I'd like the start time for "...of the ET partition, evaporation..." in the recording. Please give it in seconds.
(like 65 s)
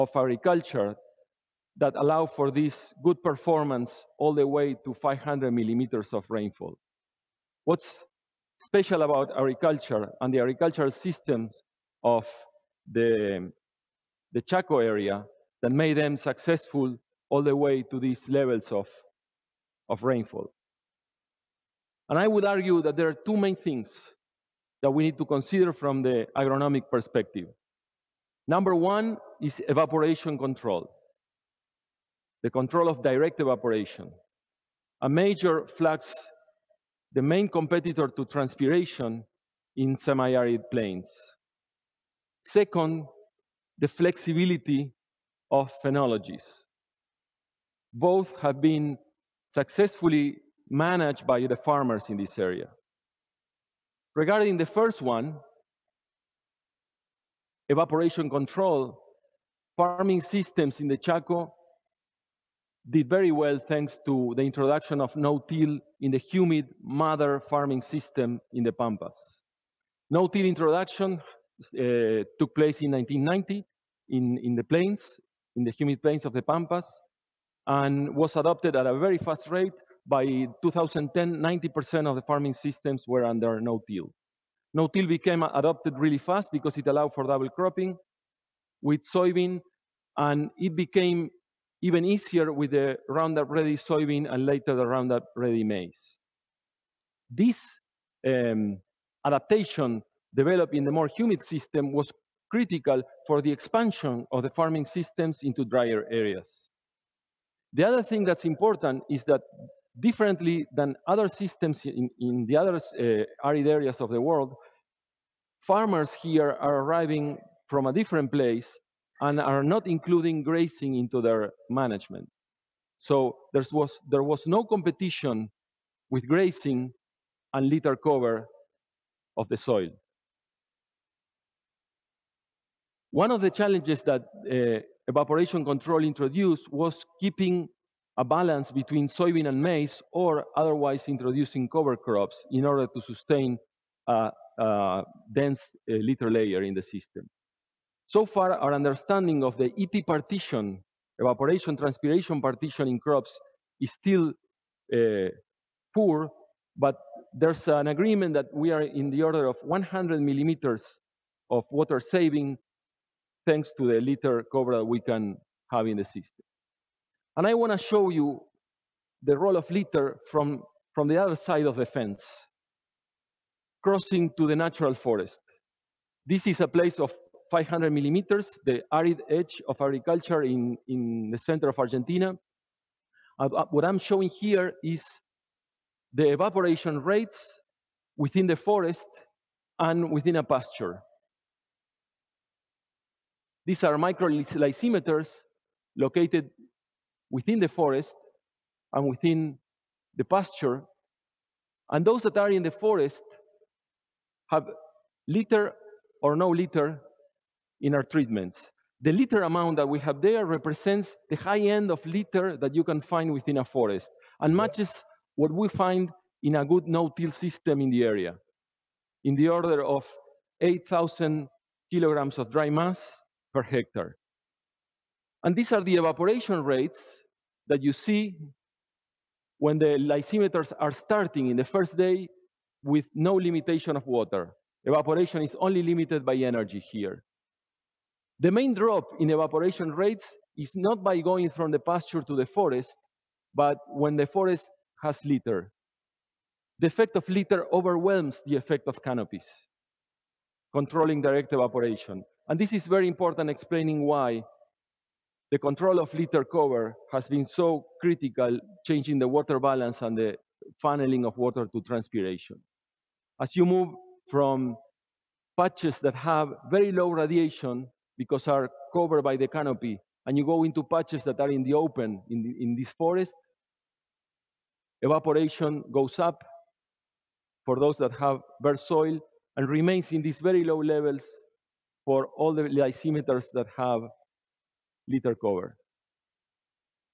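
149 s.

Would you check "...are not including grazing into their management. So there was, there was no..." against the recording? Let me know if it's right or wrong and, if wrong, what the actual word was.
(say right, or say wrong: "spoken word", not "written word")
right.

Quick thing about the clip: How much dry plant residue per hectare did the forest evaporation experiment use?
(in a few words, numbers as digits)
8,000 kilograms.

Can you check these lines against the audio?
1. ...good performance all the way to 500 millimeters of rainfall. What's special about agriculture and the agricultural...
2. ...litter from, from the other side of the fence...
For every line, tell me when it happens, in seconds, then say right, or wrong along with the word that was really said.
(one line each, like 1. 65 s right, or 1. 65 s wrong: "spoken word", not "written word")
1. 3 s right
2. 169 s right.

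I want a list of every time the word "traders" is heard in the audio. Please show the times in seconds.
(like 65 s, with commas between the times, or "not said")
not said.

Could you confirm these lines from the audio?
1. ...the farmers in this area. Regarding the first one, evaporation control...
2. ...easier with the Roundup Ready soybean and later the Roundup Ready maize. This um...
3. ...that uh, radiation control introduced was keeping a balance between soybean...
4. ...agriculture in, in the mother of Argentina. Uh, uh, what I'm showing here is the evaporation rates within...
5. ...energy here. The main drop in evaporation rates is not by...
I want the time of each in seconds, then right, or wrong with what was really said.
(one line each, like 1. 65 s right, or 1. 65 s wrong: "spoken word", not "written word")
1. 51 s right
2. 92 s right
3. 134 s wrong: "evaporation", not "radiation"
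4. 179 s wrong: "center", not "mother"
5. 236 s right.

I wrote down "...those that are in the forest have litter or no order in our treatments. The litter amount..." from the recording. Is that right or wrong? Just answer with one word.
wrong.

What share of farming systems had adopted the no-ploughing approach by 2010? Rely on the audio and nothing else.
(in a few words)
90%.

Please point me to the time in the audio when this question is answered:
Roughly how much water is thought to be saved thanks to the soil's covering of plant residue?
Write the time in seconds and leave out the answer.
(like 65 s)
159 s.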